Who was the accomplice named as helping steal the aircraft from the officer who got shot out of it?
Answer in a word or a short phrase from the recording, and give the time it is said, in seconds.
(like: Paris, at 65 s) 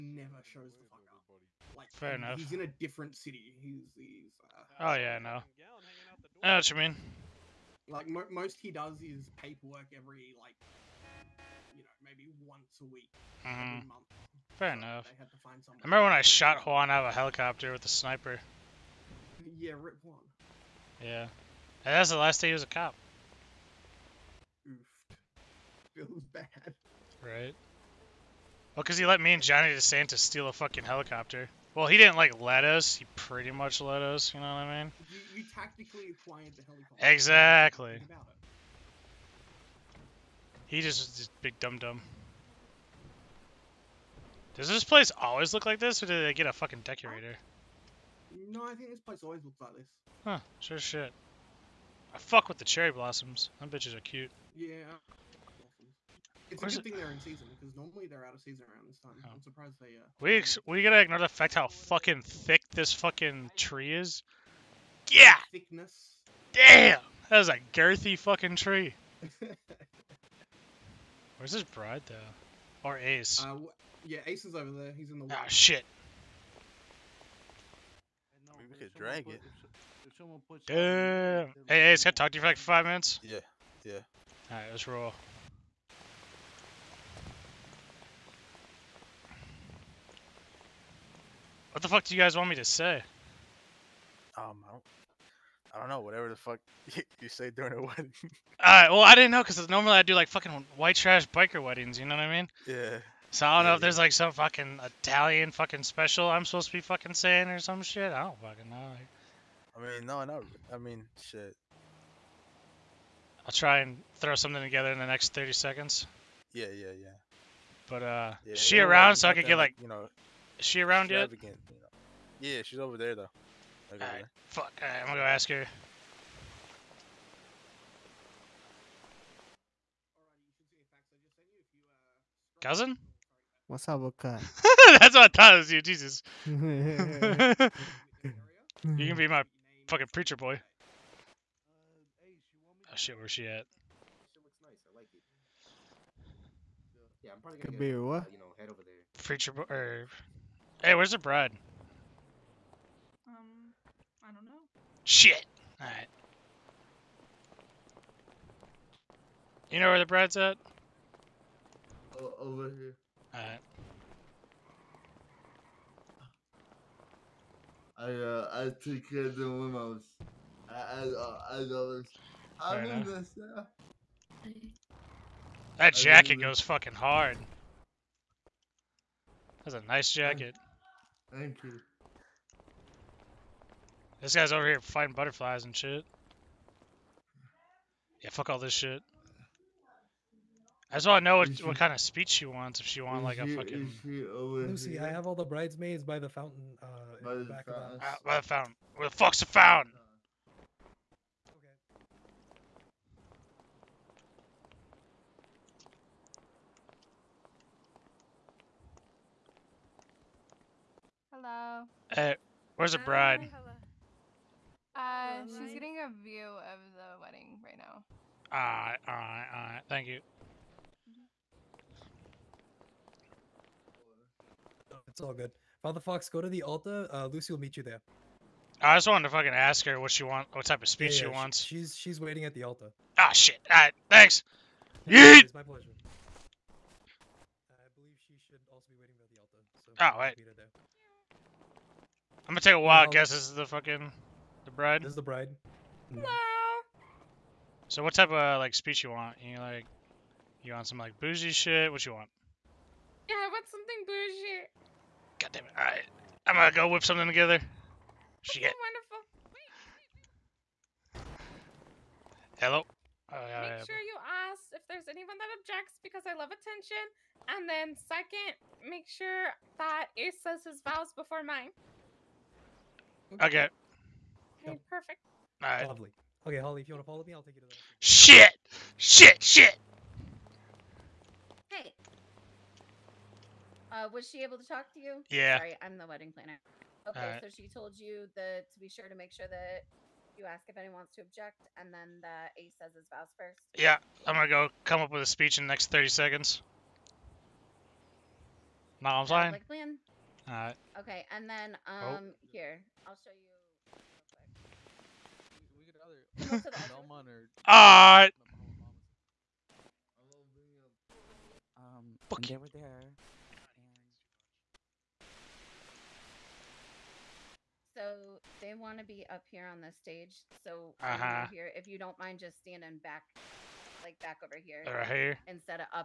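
Johnny DeSantis, at 29 s.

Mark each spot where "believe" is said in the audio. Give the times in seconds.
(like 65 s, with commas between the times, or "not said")
237 s.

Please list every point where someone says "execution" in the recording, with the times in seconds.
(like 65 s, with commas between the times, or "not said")
not said.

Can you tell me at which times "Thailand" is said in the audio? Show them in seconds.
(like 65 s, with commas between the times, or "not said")
not said.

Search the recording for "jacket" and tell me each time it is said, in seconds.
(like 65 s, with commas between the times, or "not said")
175 s, 180 s.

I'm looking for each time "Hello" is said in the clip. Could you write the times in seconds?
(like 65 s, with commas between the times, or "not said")
211 s, 262 s.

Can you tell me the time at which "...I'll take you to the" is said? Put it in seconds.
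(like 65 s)
277 s.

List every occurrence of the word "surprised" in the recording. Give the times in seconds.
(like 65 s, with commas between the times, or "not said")
59 s.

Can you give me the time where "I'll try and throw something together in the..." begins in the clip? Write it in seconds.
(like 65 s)
113 s.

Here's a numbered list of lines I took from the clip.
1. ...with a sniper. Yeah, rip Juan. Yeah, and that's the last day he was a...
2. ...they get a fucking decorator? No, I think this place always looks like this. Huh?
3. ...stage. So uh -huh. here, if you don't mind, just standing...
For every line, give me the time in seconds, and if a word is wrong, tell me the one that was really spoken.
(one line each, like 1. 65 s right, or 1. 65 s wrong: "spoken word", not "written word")
1. 17 s right
2. 46 s right
3. 320 s right.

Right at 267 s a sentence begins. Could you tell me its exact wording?
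And then second, make sure that Ace says his vows before mine.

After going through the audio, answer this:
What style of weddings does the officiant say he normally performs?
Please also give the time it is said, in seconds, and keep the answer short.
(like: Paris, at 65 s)
White trash biker weddings, at 100 s.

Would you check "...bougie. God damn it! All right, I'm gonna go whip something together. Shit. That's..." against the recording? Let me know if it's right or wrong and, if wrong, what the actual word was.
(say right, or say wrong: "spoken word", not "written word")
right.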